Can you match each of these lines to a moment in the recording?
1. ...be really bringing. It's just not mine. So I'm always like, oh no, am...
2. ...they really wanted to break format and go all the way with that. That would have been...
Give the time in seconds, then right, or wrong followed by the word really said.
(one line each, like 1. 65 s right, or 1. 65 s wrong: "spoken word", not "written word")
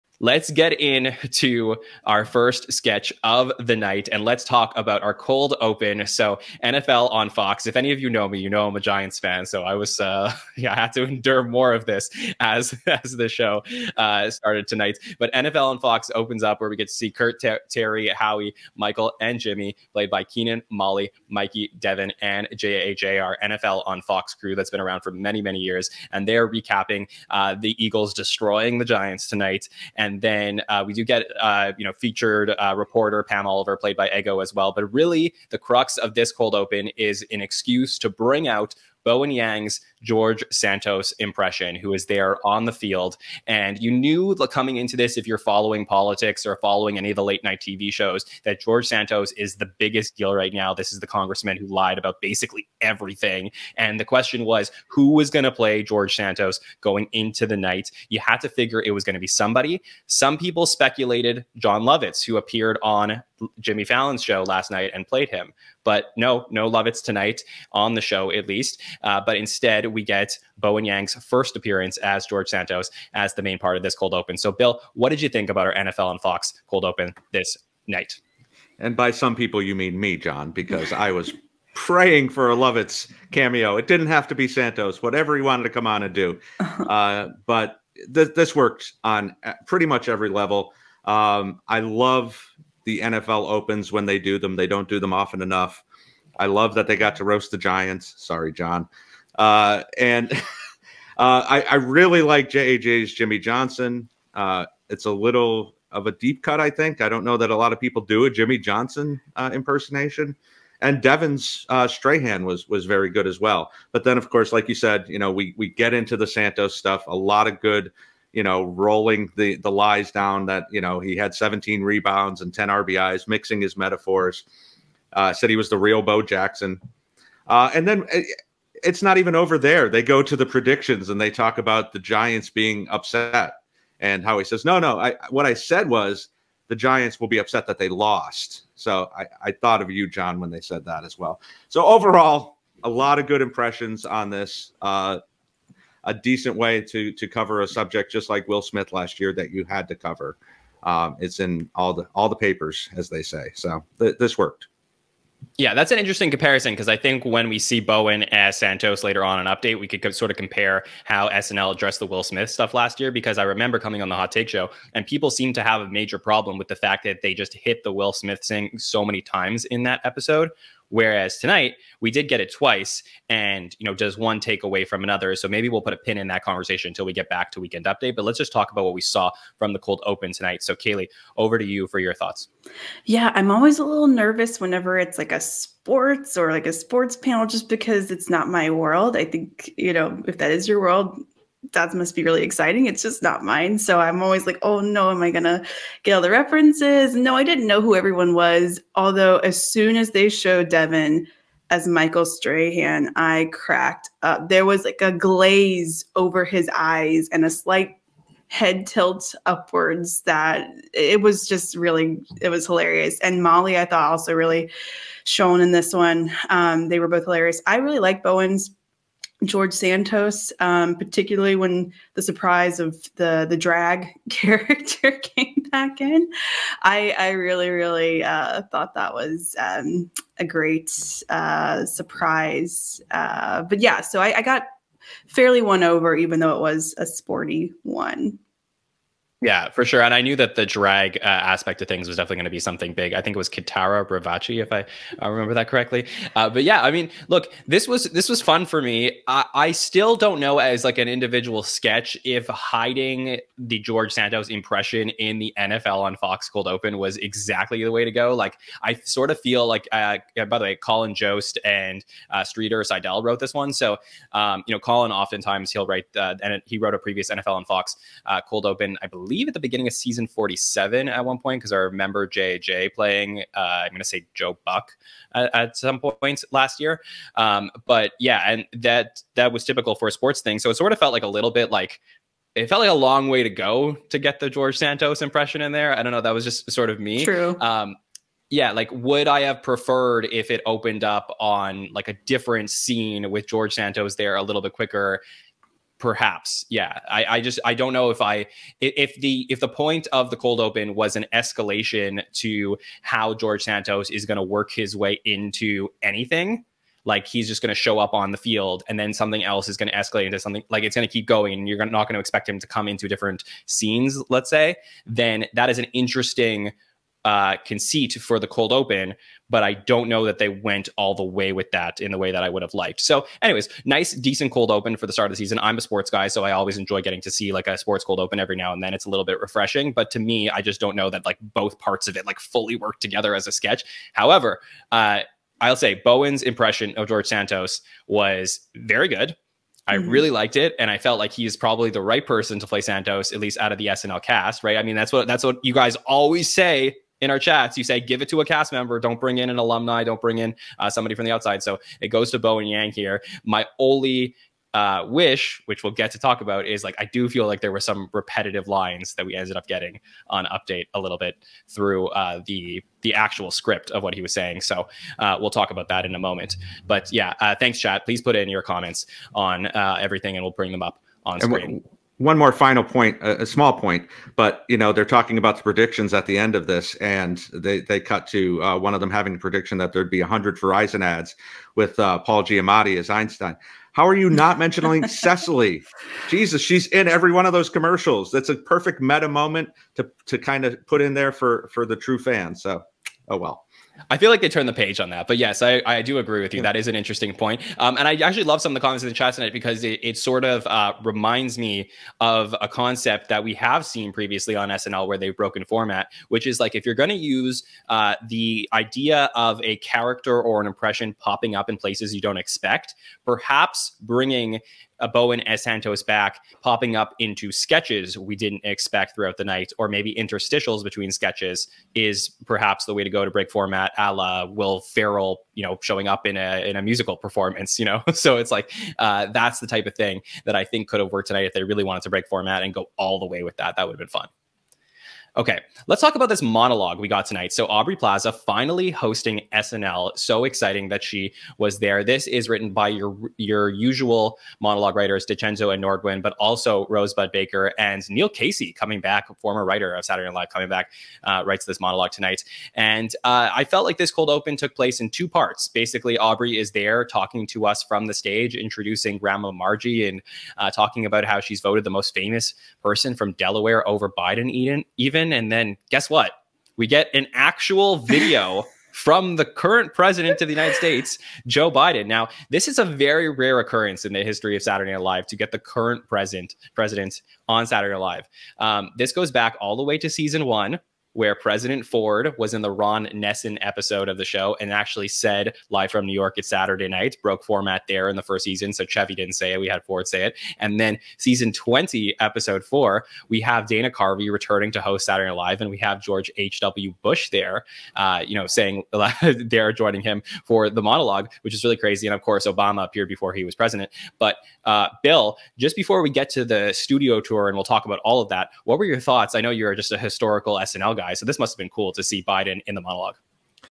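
1. 192 s wrong: "exciting", not "bringing"
2. 431 s right.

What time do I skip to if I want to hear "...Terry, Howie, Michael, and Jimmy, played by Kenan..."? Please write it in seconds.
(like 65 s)
17 s.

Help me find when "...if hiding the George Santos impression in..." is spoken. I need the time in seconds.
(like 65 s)
252 s.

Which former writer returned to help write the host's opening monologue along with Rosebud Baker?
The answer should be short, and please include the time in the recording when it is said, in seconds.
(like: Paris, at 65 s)
Neil Casey, at 448 s.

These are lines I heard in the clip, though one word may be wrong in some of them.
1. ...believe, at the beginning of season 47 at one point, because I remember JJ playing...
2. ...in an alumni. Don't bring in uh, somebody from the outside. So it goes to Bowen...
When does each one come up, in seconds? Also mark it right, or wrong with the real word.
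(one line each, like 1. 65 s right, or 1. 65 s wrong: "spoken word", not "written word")
1. 269 s right
2. 349 s right.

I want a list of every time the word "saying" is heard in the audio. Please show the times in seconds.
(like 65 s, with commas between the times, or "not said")
364 s, 498 s.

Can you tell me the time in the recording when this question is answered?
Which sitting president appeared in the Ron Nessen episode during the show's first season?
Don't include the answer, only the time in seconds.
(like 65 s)
481 s.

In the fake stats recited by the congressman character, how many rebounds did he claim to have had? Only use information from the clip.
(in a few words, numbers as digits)
17.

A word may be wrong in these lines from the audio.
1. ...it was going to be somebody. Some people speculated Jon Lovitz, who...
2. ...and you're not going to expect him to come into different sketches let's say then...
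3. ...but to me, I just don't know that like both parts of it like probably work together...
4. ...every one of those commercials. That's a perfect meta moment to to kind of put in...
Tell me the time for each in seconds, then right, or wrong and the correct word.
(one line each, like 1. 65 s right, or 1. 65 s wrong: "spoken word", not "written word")
1. 58 s right
2. 311 s wrong: "scenes", not "sketches"
3. 329 s wrong: "fully", not "probably"
4. 387 s right.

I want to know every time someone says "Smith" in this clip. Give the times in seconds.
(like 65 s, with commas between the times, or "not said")
148 s, 162 s, 168 s.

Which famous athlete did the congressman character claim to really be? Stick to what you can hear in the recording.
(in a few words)
Bo Jackson.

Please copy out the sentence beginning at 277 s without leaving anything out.
Um, but yeah, and that that was typical for a sports thing.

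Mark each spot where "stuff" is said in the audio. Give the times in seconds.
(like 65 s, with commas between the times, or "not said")
116 s, 162 s.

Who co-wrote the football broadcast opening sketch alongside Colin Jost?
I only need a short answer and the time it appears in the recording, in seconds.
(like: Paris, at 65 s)
Streeter Seidel, at 262 s.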